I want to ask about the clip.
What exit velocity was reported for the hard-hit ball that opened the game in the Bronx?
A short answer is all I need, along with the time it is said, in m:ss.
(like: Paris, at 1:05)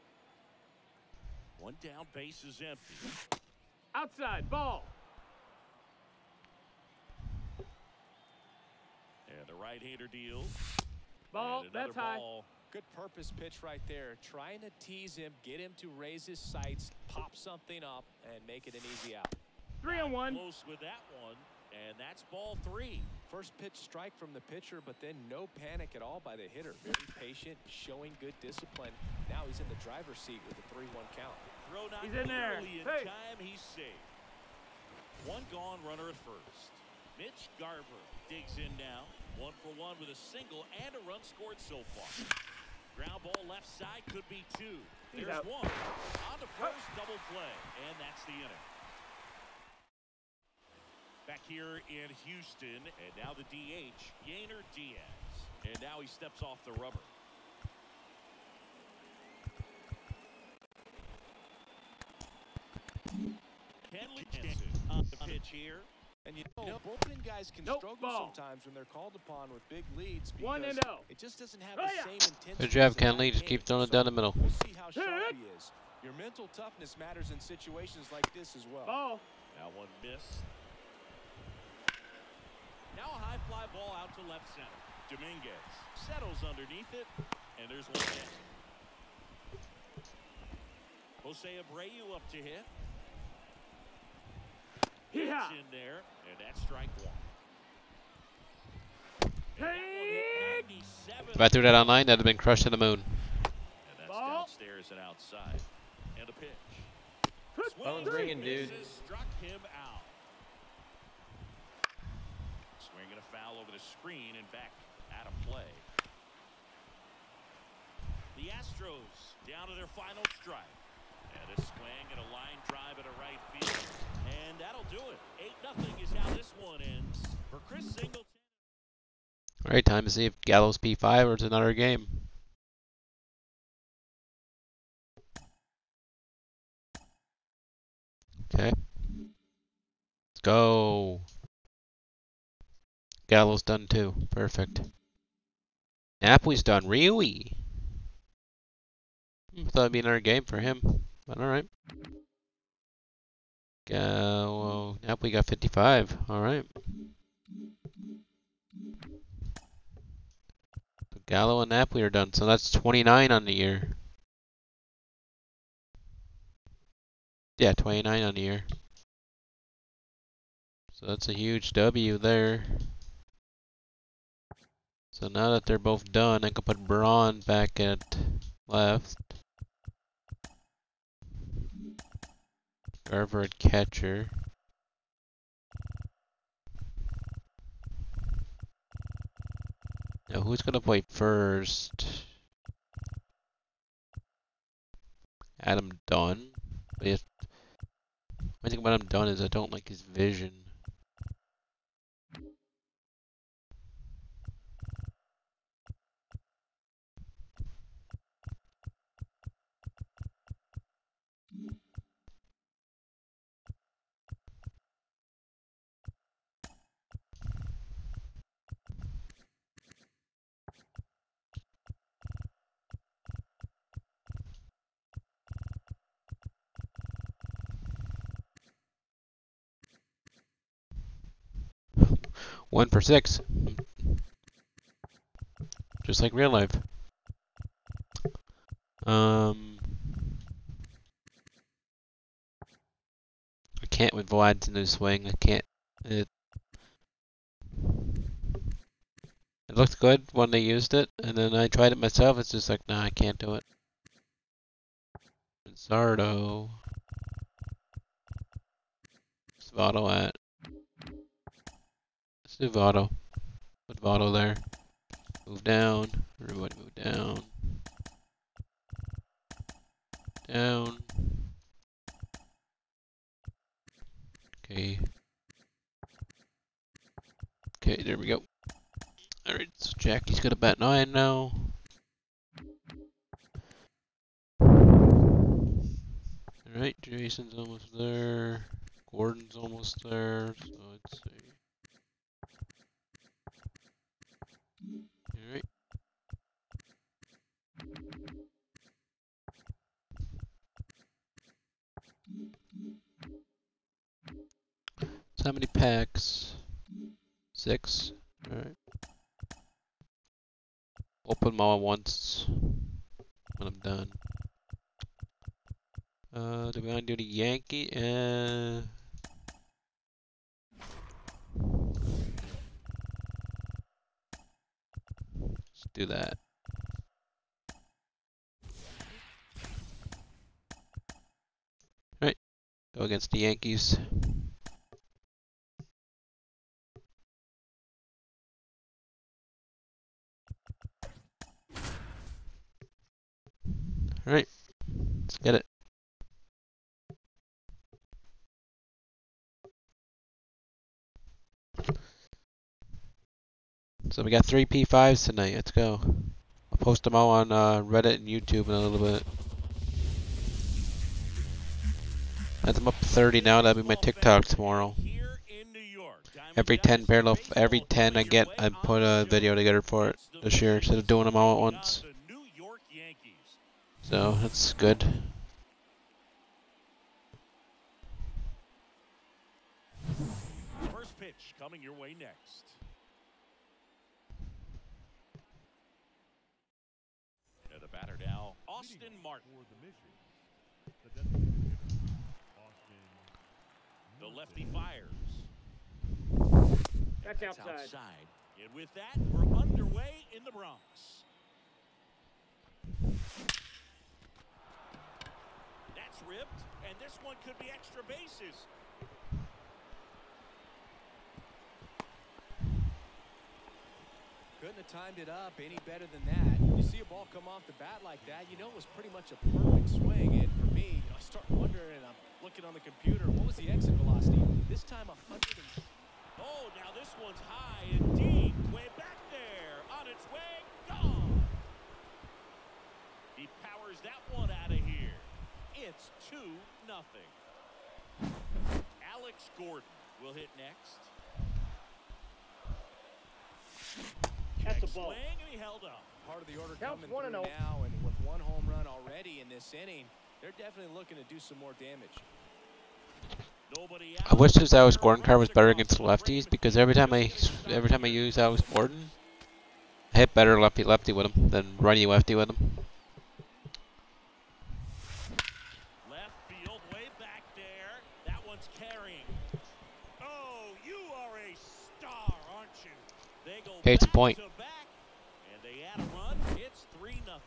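100, at 7:05.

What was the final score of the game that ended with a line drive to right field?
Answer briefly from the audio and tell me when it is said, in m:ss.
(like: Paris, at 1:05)
8-0, at 2:05.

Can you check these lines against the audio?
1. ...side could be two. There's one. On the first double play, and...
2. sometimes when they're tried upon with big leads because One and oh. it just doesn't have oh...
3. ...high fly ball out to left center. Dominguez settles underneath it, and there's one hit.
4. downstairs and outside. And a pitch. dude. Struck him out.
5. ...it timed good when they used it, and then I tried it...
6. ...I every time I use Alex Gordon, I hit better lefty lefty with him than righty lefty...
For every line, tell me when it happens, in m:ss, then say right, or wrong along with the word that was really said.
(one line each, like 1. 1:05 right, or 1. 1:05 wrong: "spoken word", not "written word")
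1. 0:43 right
2. 1:08 wrong: "called", not "tried"
3. 1:23 right
4. 1:44 right
5. 4:07 wrong: "looked", not "timed"
6. 7:37 right.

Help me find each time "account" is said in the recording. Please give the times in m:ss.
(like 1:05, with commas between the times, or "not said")
not said.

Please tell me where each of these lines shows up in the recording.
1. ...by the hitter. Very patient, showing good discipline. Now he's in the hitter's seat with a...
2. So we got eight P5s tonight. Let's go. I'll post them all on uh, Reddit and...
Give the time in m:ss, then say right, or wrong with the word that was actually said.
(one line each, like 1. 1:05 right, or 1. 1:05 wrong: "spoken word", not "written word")
1. 0:26 wrong: "driver", not "hitter"
2. 5:54 wrong: "three", not "eight".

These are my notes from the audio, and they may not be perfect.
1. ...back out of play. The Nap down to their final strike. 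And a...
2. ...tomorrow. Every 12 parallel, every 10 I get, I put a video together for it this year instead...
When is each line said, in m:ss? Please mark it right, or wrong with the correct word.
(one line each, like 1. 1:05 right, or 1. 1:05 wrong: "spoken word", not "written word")
1. 1:54 wrong: "Astros", not "Nap"
2. 6:04 wrong: "10", not "12".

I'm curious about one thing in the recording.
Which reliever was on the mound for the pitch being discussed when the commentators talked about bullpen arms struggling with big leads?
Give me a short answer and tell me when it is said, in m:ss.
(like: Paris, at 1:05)
Kenley Jansen, at 1:03.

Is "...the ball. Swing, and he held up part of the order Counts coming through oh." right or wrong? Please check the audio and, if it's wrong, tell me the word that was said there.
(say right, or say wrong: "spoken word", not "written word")
right.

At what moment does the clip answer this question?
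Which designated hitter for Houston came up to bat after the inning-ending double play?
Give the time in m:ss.
0:54.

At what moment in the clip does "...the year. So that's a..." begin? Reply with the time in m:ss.
2:48.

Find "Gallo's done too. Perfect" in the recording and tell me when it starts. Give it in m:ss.
2:23.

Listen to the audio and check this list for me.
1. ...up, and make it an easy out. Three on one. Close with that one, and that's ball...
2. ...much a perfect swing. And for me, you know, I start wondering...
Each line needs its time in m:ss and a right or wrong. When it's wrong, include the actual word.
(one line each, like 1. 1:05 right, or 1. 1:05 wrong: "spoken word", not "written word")
1. 0:17 right
2. 6:59 right.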